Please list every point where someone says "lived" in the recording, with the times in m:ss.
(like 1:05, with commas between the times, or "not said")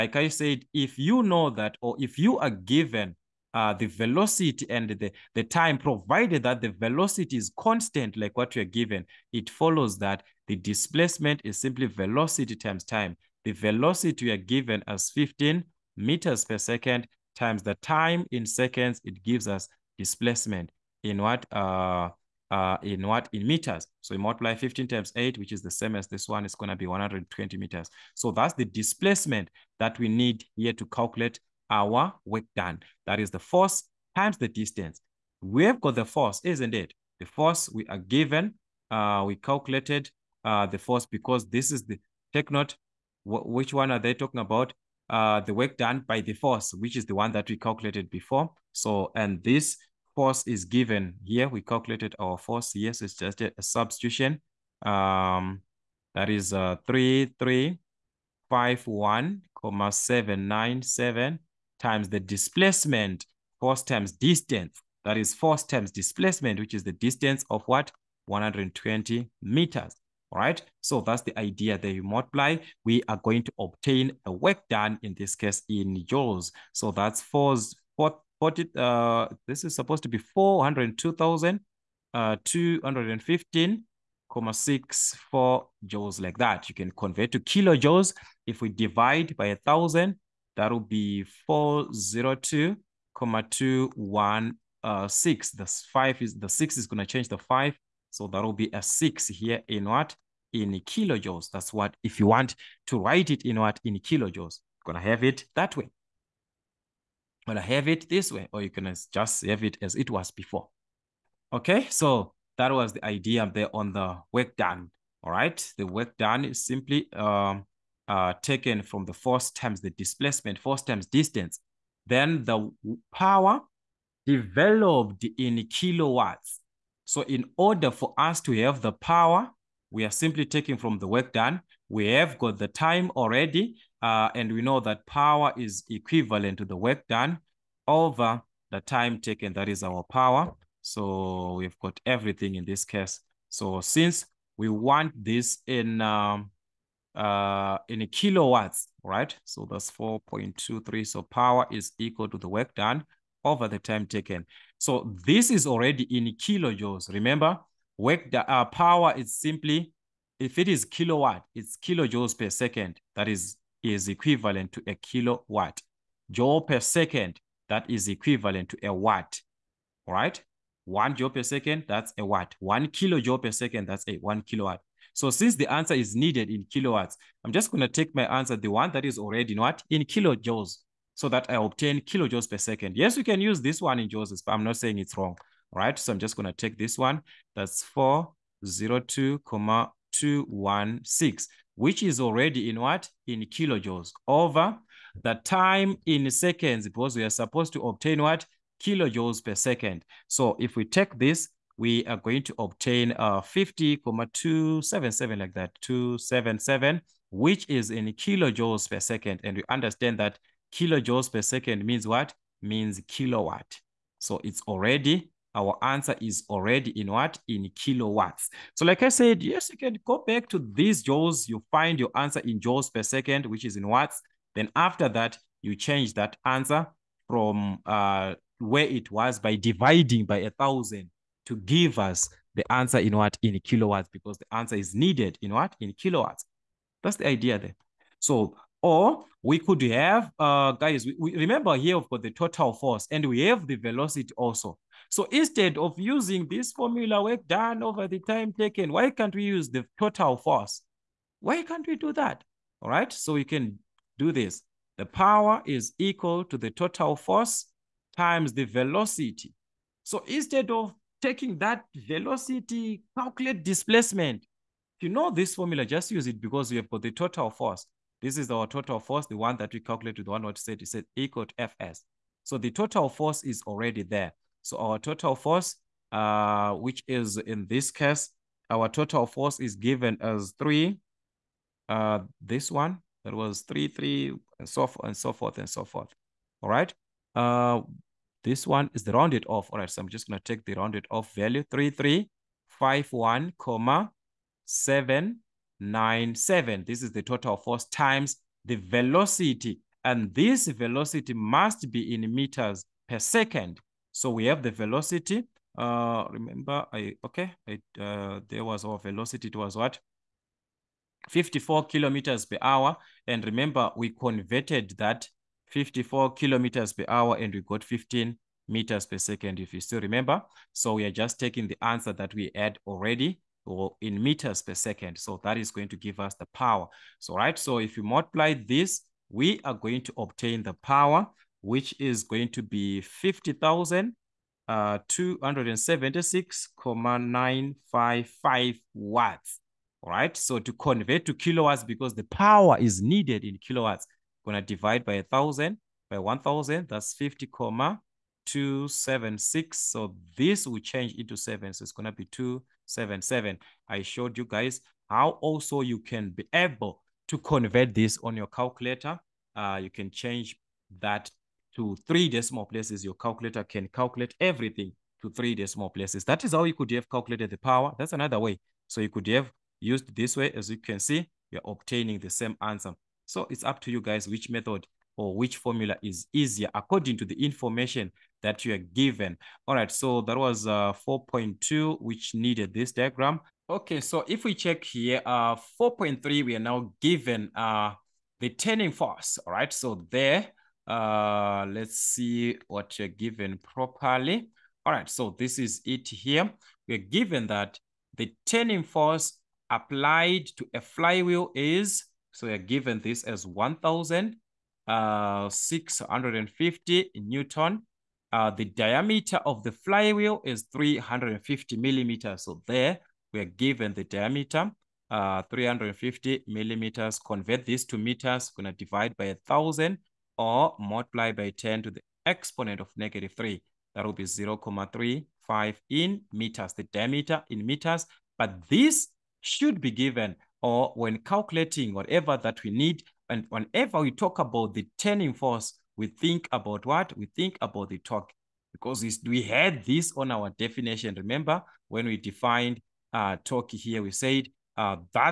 not said.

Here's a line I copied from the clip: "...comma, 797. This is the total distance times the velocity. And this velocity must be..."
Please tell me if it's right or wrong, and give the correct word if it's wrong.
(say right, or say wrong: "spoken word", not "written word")
wrong: "force", not "distance".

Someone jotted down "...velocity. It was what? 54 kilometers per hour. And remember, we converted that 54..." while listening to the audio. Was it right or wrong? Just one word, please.
right.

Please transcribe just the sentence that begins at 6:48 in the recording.
Uh, the diameter of the flywheel is 350 millimeters.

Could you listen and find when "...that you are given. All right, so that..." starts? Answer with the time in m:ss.
6:18.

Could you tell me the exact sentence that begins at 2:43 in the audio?
That is, is equivalent to a kilowatt.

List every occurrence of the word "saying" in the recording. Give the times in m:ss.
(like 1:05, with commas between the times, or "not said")
3:04.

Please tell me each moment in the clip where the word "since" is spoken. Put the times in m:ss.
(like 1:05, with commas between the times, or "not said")
2:23, 2:55.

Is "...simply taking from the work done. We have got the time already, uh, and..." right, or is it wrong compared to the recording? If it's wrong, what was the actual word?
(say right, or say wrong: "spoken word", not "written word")
right.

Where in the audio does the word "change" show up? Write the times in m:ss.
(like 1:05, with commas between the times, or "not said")
1:37, 3:45, 5:50, 6:00.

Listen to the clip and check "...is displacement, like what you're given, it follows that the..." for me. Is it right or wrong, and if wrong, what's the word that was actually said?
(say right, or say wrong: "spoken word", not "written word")
wrong: "constant", not "displacement".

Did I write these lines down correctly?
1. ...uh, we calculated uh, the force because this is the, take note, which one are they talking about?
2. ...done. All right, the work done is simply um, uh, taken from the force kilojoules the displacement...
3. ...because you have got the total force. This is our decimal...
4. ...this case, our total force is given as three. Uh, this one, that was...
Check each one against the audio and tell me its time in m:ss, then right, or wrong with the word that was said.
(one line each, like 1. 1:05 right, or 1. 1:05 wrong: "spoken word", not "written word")
1. 0:38 right
2. 1:54 wrong: "times", not "kilojoules"
3. 4:26 wrong: "total", not "decimal"
4. 4:37 right.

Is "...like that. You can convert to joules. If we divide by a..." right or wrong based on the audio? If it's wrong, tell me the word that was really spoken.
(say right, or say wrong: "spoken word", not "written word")
wrong: "kilojoules", not "joules".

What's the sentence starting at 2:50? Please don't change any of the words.
One joule per second, that's a watt.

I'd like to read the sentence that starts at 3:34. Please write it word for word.
So it's already, our answer is already in what?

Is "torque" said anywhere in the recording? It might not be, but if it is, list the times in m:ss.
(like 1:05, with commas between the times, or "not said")
7:17, 7:23.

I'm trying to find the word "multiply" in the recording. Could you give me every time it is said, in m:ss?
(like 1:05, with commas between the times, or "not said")
0:24, 1:12, 5:28, 7:00.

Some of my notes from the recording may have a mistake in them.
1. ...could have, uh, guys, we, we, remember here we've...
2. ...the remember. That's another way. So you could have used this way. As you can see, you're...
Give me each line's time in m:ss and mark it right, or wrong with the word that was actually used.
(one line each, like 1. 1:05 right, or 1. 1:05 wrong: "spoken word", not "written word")
1. 3:59 right
2. 6:07 wrong: "power", not "remember".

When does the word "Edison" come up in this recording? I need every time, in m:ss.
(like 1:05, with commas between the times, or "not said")
not said.